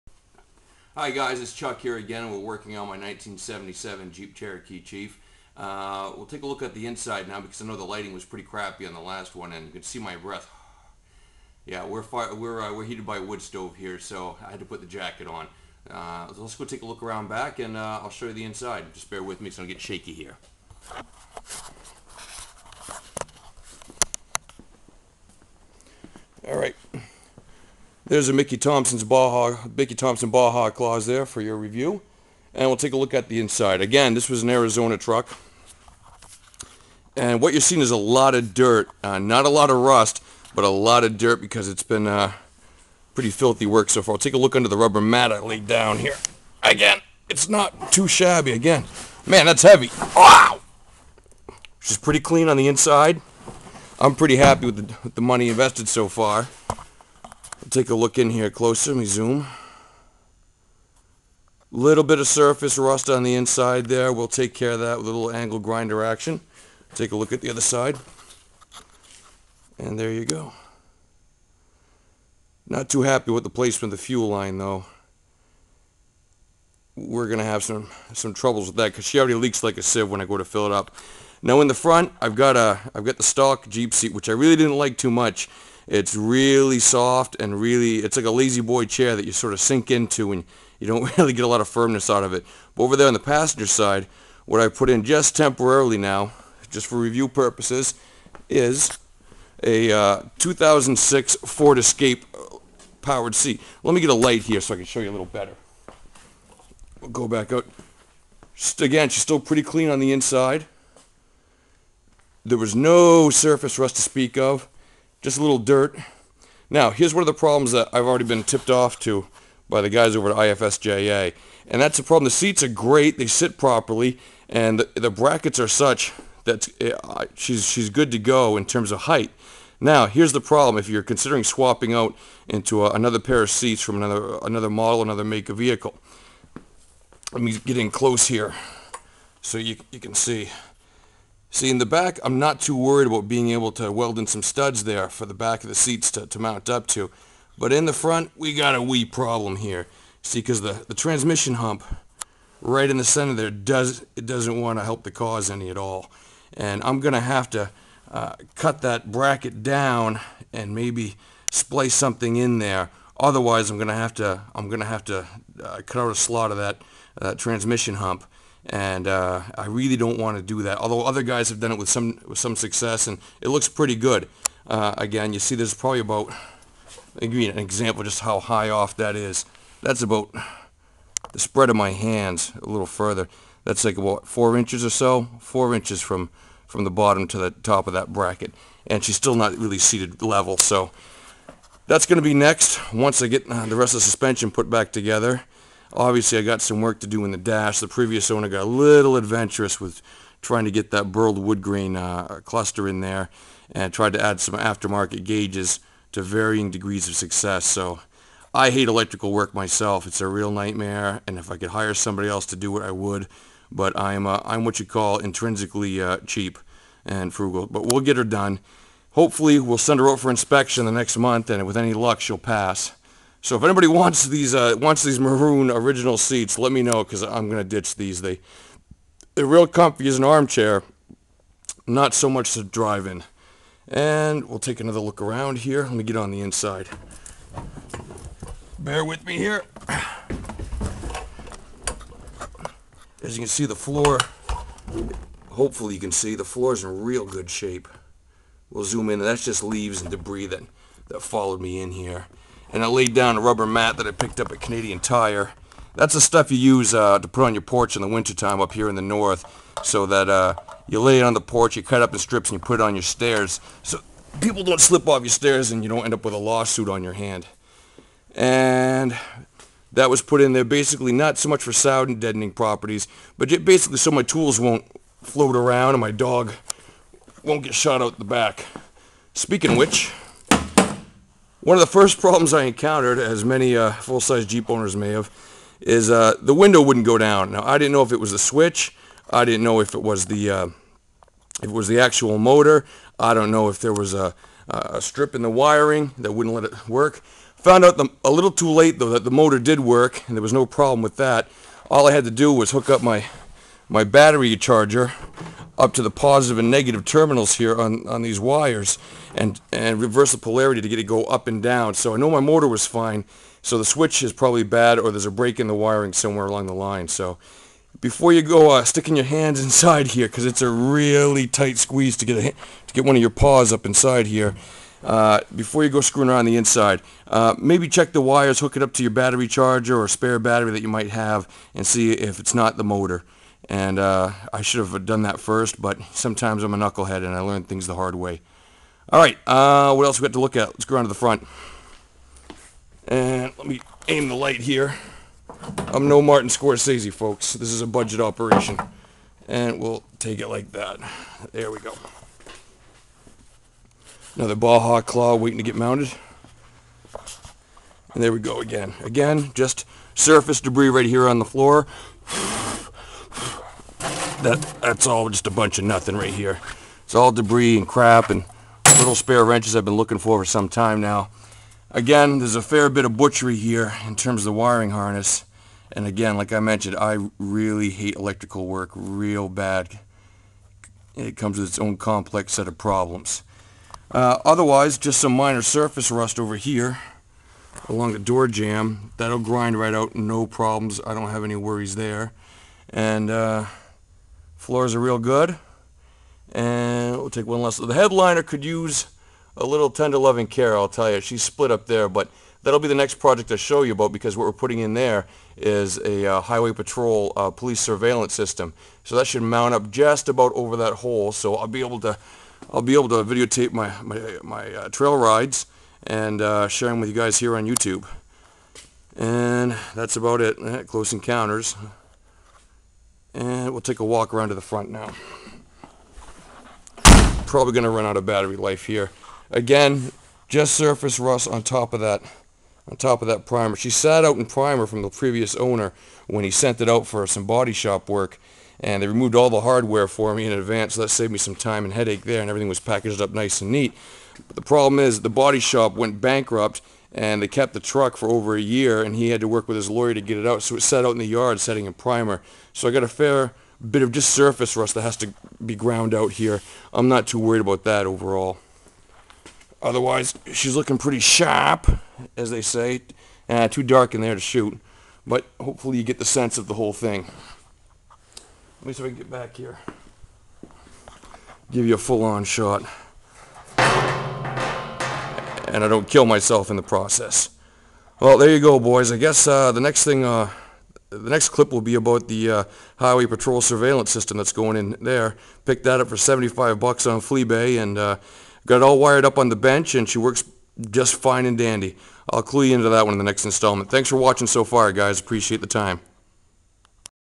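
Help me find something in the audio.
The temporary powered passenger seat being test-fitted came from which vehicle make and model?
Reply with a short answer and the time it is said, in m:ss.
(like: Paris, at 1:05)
Ford Escape, at 1:41.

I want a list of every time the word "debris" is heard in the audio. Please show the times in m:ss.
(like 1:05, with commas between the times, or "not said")
4:10, 6:00, 6:07.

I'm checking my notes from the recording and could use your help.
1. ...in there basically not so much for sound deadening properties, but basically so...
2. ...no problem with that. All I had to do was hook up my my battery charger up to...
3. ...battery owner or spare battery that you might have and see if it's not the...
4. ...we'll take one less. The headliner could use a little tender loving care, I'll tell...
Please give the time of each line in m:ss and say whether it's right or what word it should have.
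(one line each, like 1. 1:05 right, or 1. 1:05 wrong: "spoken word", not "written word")
1. 4:30 right
2. 5:00 right
3. 5:29 wrong: "charger", not "owner"
4. 6:37 right.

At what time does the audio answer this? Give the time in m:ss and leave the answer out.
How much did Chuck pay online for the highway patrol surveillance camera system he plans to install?
8:06.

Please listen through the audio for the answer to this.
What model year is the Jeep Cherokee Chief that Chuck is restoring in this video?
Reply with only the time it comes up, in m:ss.
0:02.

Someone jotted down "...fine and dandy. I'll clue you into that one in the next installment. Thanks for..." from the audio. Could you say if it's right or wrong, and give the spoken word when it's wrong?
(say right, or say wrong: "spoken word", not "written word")
right.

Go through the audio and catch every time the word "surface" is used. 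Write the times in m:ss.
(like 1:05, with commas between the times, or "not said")
1:02, 1:53, 6:00, 6:25, 7:10, 7:34.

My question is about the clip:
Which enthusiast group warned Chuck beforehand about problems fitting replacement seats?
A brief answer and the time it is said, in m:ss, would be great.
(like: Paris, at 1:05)
IFSJA, at 2:00.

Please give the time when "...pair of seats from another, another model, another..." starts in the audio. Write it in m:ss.
2:13.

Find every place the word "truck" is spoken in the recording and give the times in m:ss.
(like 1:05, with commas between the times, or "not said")
0:34, 7:27.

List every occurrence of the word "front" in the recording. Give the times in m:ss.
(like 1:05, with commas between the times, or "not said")
1:21, 2:27, 5:41, 7:04.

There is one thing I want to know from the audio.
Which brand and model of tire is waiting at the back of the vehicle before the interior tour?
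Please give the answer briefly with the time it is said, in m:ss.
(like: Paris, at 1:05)
Mickey Thompson Baja Claws, at 0:29.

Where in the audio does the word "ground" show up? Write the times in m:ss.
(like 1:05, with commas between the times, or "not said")
7:35.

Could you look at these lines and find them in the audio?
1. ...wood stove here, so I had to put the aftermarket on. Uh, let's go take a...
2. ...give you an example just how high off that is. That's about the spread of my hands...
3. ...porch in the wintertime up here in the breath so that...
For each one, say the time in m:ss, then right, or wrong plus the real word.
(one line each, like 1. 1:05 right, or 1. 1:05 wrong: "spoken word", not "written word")
1. 0:13 wrong: "jacket", not "aftermarket"
2. 2:57 right
3. 4:17 wrong: "north", not "breath".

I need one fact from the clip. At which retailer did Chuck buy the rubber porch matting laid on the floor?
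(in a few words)
Canadian Tire.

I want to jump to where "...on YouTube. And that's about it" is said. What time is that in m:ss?
6:57.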